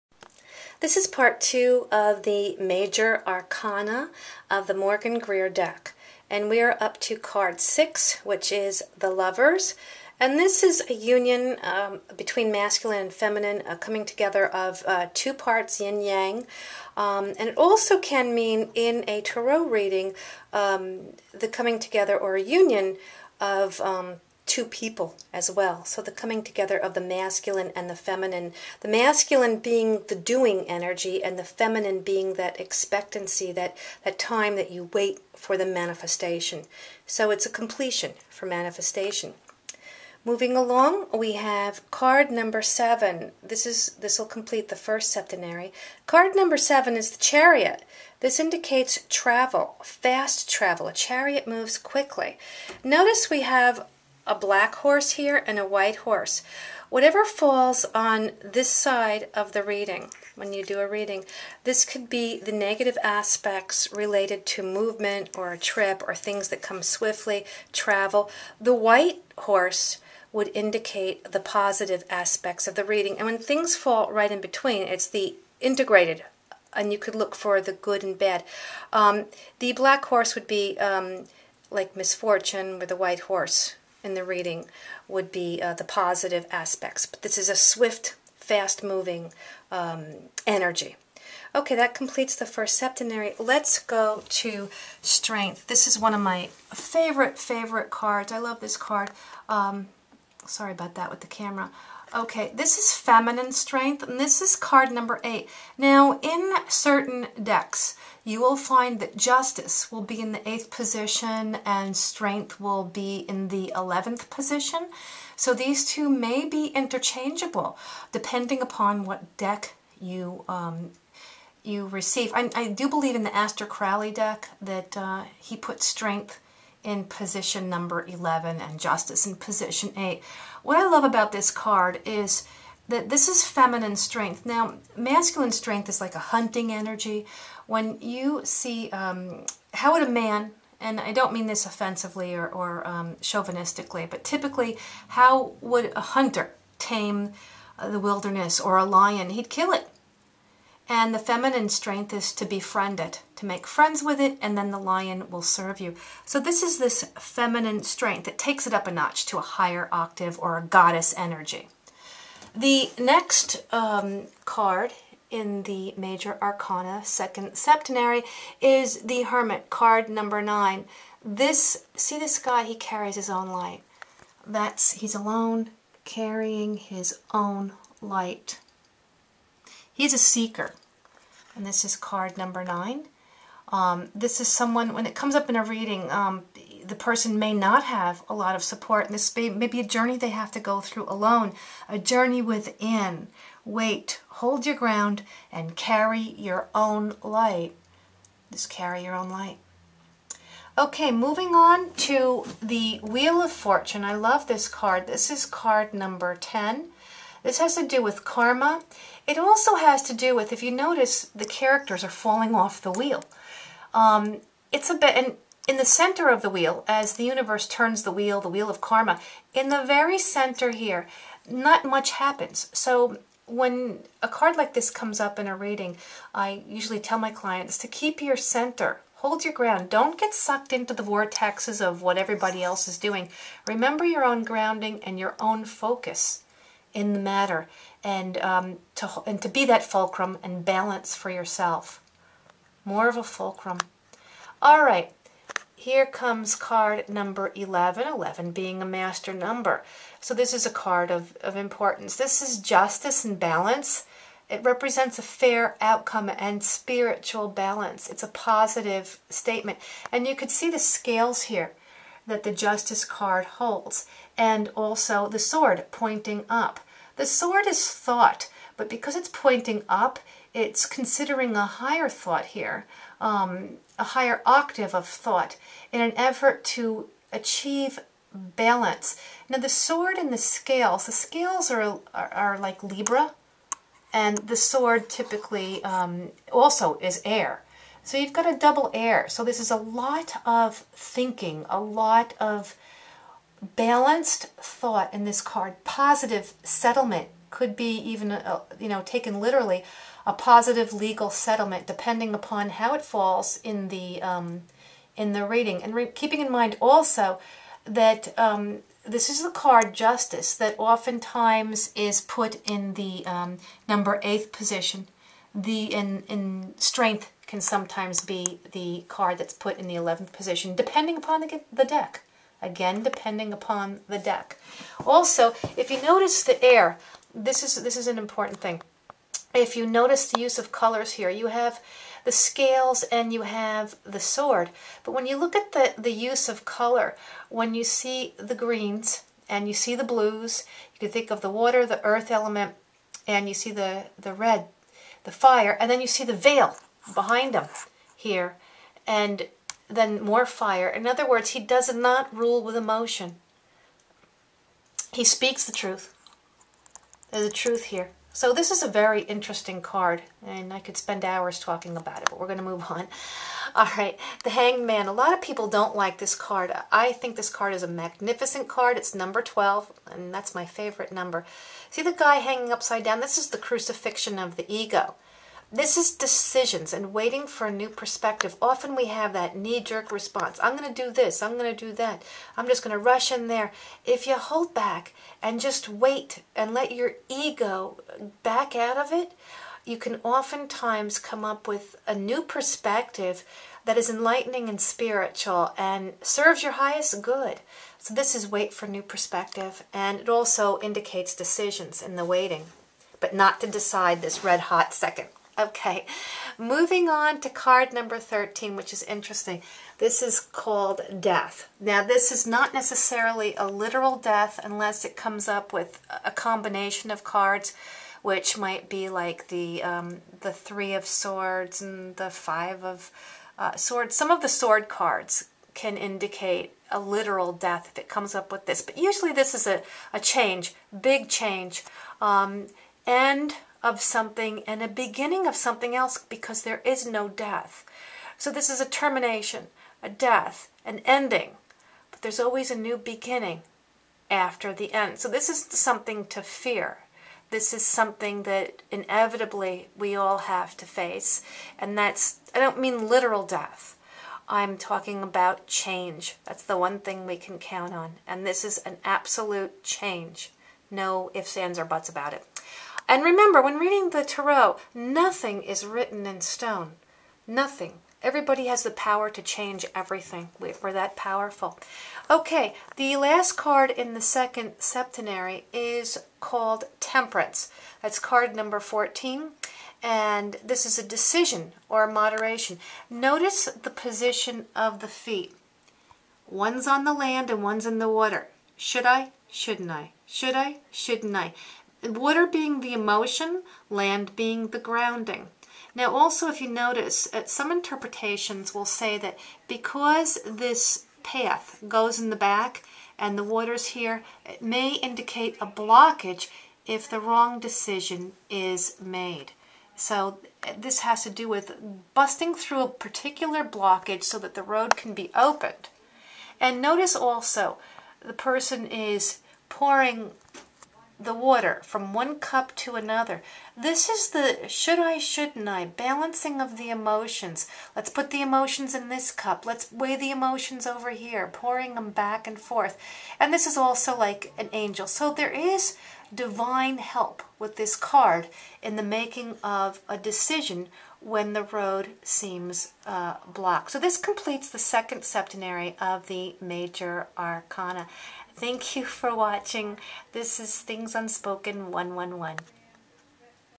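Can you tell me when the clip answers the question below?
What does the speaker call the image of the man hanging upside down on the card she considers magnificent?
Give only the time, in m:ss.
6:13.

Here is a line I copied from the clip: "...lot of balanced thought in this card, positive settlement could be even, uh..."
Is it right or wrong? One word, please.
right.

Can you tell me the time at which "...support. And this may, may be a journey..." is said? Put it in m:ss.
3:08.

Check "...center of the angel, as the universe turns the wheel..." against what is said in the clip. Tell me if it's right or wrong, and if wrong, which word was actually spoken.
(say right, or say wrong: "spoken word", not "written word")
wrong: "wheel", not "angel".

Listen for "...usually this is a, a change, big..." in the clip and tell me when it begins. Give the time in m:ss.
7:08.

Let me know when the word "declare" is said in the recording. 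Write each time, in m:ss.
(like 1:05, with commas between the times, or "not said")
not said.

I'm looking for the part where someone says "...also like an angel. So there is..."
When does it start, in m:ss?
8:53.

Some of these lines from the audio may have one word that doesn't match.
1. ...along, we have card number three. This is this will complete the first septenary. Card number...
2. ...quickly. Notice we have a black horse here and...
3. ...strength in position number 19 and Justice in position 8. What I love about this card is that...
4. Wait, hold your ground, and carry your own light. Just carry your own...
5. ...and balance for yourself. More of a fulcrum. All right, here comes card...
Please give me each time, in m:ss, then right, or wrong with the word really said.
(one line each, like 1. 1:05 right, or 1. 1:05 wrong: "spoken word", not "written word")
1. 0:40 wrong: "seven", not "three"
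2. 0:51 right
3. 2:05 wrong: "11", not "19"
4. 3:13 right
5. 4:00 right.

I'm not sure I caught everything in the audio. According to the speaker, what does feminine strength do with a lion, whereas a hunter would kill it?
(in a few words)
Befriend it.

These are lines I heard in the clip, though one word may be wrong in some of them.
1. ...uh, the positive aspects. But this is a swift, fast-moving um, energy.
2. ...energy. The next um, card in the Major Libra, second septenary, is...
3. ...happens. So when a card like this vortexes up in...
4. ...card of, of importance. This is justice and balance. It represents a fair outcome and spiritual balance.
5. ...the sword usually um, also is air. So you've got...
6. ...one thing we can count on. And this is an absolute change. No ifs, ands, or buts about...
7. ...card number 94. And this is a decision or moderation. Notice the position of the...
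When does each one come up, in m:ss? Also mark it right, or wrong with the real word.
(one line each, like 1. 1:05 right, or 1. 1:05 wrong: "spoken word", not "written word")
1. 1:25 right
2. 2:41 wrong: "Arcana", not "Libra"
3. 3:42 wrong: "comes", not "vortexes"
4. 4:10 right
5. 4:44 wrong: "typically", not "usually"
6. 7:36 right
7. 7:58 wrong: "14", not "94".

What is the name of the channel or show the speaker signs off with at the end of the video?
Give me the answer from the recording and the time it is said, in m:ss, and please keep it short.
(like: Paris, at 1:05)
Things Unspoken 111, at 9:10.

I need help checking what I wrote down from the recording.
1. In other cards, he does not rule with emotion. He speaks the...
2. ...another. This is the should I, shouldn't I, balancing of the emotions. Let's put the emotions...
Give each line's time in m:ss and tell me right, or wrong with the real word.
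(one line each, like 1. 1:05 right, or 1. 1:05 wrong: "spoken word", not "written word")
1. 5:50 wrong: "words", not "cards"
2. 8:42 right.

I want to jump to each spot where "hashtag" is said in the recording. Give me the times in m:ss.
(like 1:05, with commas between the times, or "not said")
not said.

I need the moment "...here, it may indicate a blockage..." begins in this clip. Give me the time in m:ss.
8:23.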